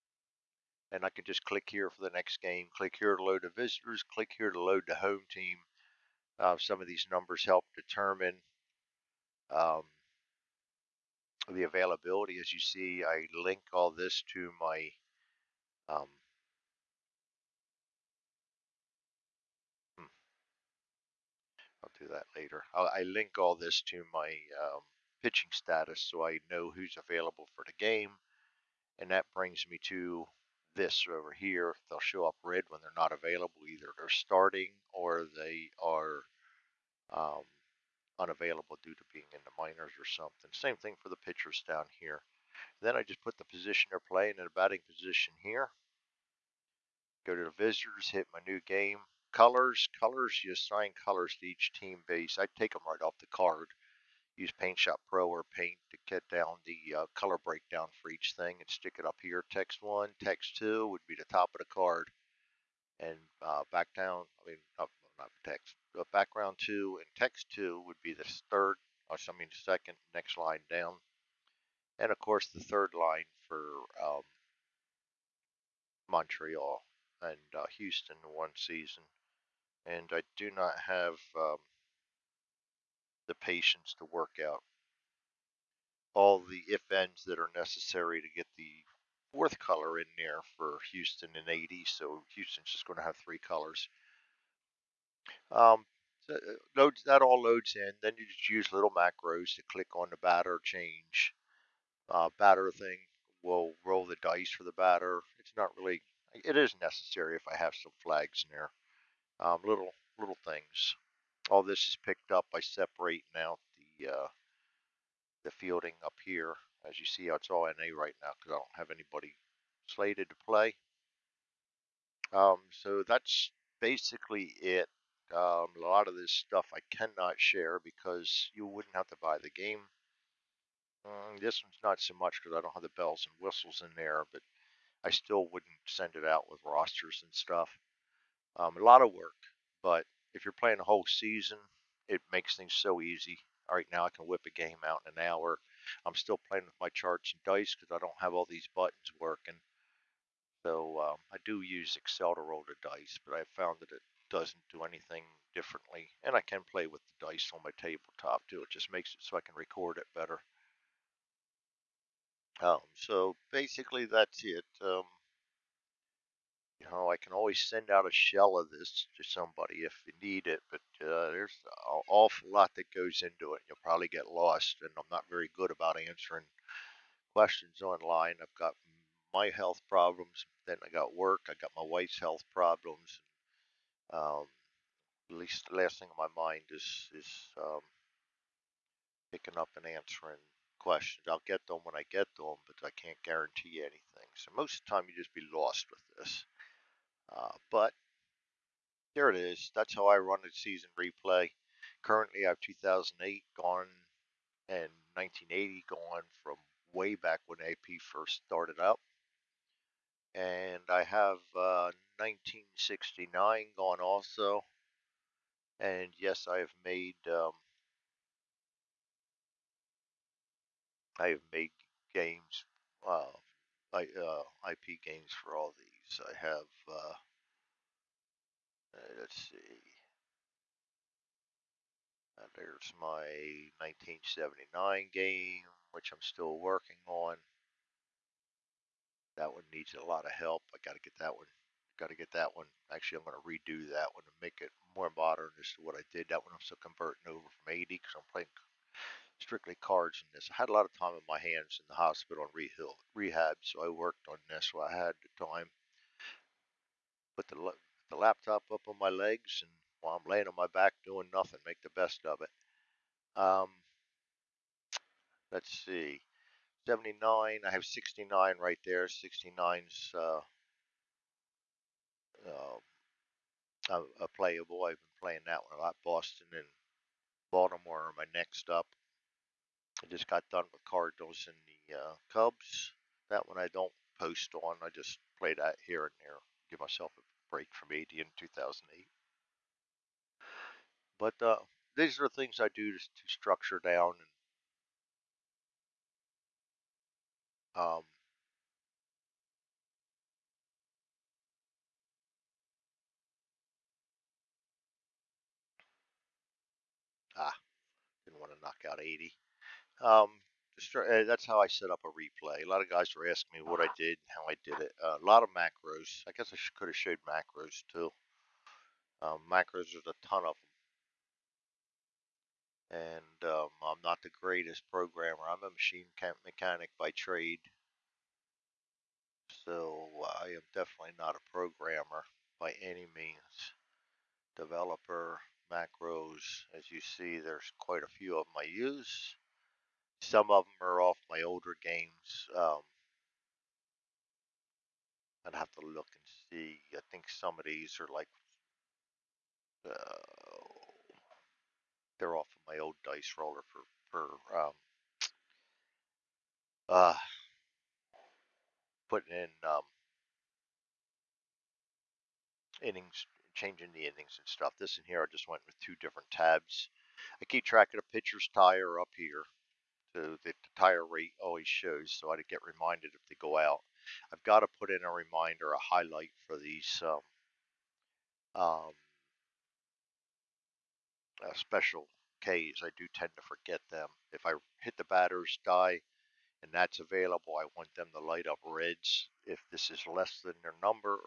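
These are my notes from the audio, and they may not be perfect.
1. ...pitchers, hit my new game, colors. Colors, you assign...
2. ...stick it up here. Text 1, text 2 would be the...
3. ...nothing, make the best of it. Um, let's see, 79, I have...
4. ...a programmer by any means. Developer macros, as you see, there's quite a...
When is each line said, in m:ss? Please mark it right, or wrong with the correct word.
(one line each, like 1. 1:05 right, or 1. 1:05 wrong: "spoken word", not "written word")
1. 0:47 wrong: "visitors", not "pitchers"
2. 0:58 right
3. 4:21 right
4. 5:31 right.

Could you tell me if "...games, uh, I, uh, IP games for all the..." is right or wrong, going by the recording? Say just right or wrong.
right.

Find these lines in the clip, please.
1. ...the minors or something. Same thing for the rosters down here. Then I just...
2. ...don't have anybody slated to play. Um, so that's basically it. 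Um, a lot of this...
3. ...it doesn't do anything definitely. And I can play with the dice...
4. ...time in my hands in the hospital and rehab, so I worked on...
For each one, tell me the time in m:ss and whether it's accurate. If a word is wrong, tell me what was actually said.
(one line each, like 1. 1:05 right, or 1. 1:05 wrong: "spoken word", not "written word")
1. 0:39 wrong: "pitchers", not "rosters"
2. 1:58 right
3. 2:33 wrong: "differently", not "definitely"
4. 4:10 right.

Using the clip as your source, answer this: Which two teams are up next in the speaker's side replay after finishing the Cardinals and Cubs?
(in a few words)
Boston and Baltimore.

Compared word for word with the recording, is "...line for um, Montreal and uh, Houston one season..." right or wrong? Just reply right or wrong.
right.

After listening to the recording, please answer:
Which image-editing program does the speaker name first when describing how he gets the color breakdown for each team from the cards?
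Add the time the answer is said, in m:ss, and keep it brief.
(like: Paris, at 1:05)
Paint Shop Pro, at 0:54.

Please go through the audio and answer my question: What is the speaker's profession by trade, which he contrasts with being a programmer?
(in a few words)
machine mechanic.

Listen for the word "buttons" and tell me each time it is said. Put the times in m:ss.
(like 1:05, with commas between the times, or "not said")
2:28.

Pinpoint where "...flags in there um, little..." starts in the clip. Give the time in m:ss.
1:48.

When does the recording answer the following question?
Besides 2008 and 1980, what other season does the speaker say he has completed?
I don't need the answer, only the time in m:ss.
3:32.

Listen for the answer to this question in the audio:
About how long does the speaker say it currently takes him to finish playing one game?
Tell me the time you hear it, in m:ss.
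2:25.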